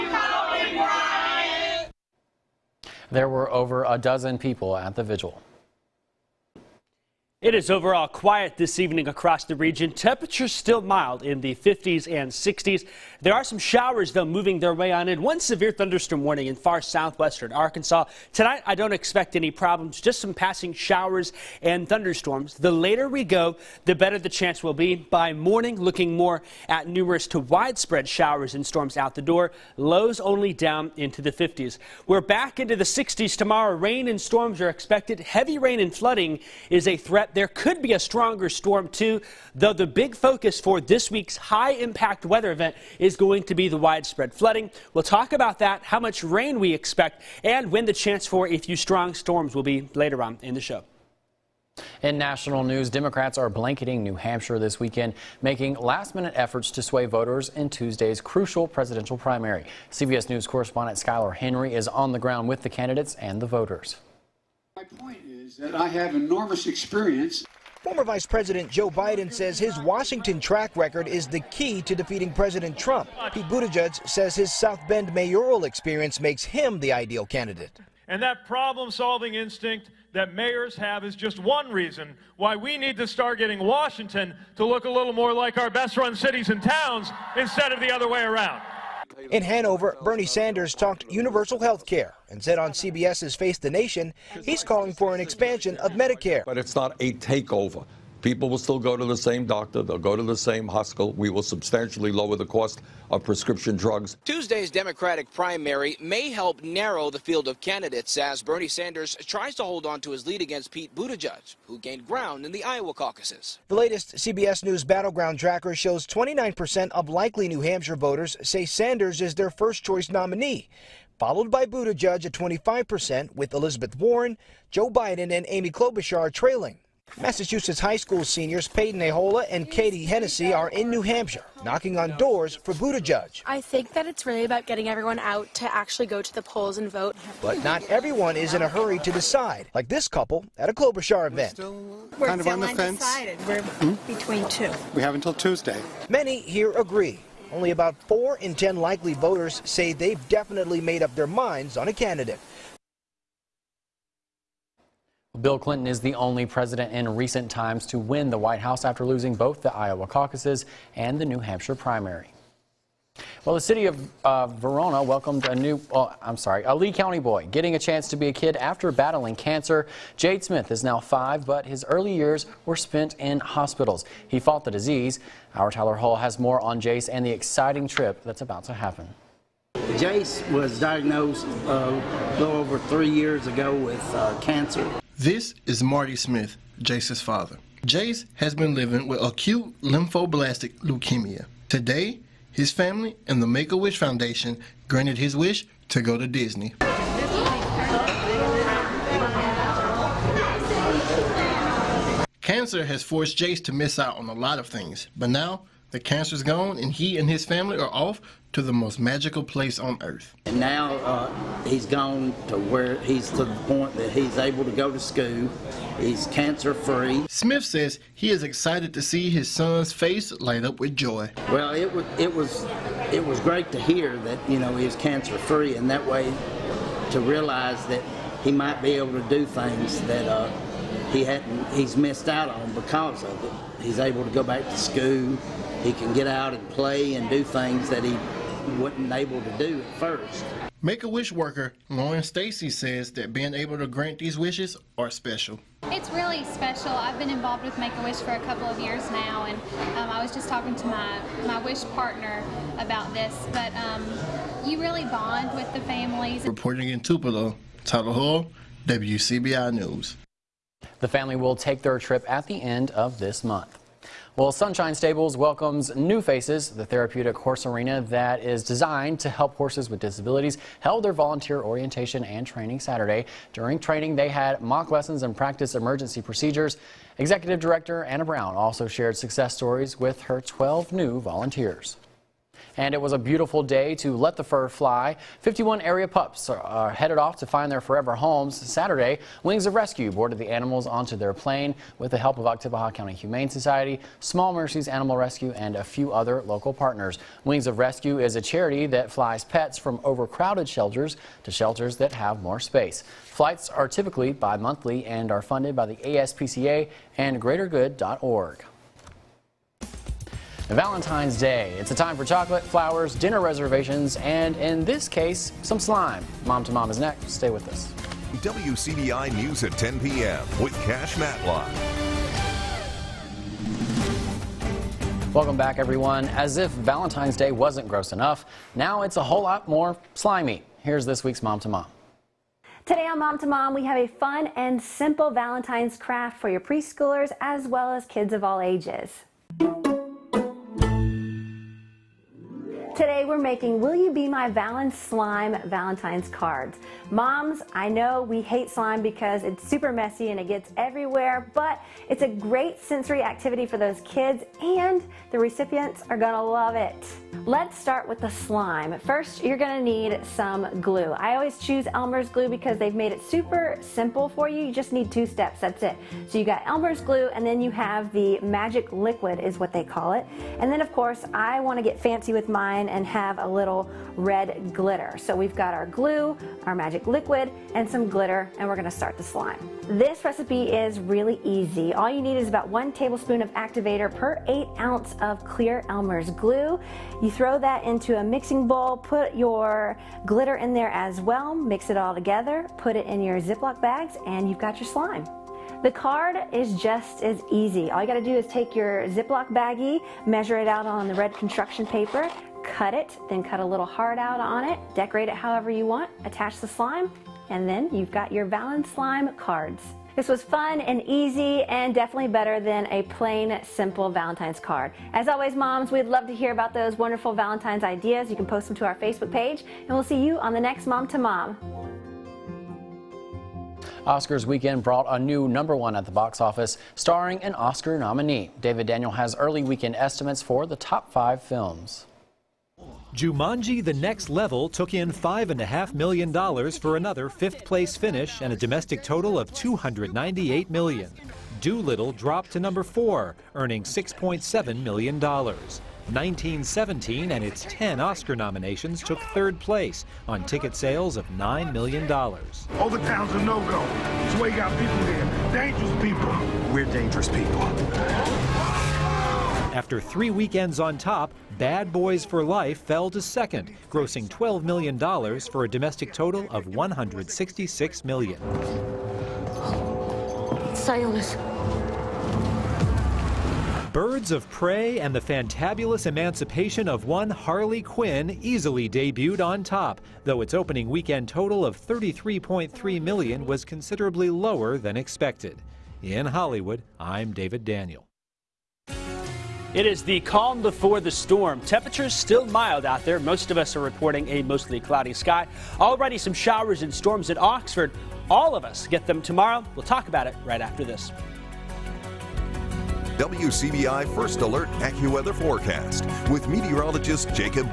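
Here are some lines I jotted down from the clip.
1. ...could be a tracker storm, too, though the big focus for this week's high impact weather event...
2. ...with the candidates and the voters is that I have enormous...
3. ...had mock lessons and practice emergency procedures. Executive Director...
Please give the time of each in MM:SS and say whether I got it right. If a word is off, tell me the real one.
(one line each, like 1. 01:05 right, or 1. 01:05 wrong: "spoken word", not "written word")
1. 00:37 wrong: "stronger", not "tracker"
2. 01:02 right
3. 04:34 right.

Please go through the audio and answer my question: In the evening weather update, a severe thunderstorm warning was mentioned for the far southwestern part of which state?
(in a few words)
Arkansas.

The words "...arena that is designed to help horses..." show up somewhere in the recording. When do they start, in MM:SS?
04:27.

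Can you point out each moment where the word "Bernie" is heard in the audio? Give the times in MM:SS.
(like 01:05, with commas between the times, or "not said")
01:30, 01:48.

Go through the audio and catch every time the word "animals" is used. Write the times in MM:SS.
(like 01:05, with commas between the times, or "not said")
04:50, 04:54.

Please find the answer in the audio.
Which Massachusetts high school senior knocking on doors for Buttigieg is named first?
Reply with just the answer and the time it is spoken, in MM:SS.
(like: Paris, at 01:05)
Peyton Ahola, at 02:08.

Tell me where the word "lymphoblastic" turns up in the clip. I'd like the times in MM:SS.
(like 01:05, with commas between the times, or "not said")
03:09.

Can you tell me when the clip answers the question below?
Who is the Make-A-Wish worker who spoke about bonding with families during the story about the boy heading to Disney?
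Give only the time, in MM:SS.
04:01.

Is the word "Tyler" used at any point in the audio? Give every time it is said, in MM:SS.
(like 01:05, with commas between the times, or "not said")
02:55, 04:17.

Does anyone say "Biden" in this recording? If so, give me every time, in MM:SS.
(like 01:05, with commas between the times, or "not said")
01:08, 02:04.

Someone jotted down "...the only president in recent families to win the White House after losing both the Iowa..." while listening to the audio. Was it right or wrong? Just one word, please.
wrong.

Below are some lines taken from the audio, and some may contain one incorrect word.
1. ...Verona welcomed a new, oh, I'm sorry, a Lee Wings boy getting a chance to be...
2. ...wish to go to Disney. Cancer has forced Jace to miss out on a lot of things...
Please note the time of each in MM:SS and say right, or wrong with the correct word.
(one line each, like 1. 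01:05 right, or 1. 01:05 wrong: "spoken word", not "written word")
1. 02:44 wrong: "County", not "Wings"
2. 03:15 right.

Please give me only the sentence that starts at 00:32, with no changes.
We're back into the 60s tomorrow.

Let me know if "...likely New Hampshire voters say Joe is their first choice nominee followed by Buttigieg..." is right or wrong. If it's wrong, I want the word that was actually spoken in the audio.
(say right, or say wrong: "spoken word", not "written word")
wrong: "Sanders", not "Joe".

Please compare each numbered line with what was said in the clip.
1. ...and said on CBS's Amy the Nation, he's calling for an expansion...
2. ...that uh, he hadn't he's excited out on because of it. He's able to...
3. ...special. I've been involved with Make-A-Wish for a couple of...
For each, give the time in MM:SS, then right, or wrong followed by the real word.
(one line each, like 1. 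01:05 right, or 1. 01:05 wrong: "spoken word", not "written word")
1. 01:32 wrong: "Face", not "Amy"
2. 03:50 wrong: "missed", not "excited"
3. 04:06 right.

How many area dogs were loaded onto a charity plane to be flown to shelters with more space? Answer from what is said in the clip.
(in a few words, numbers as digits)
51.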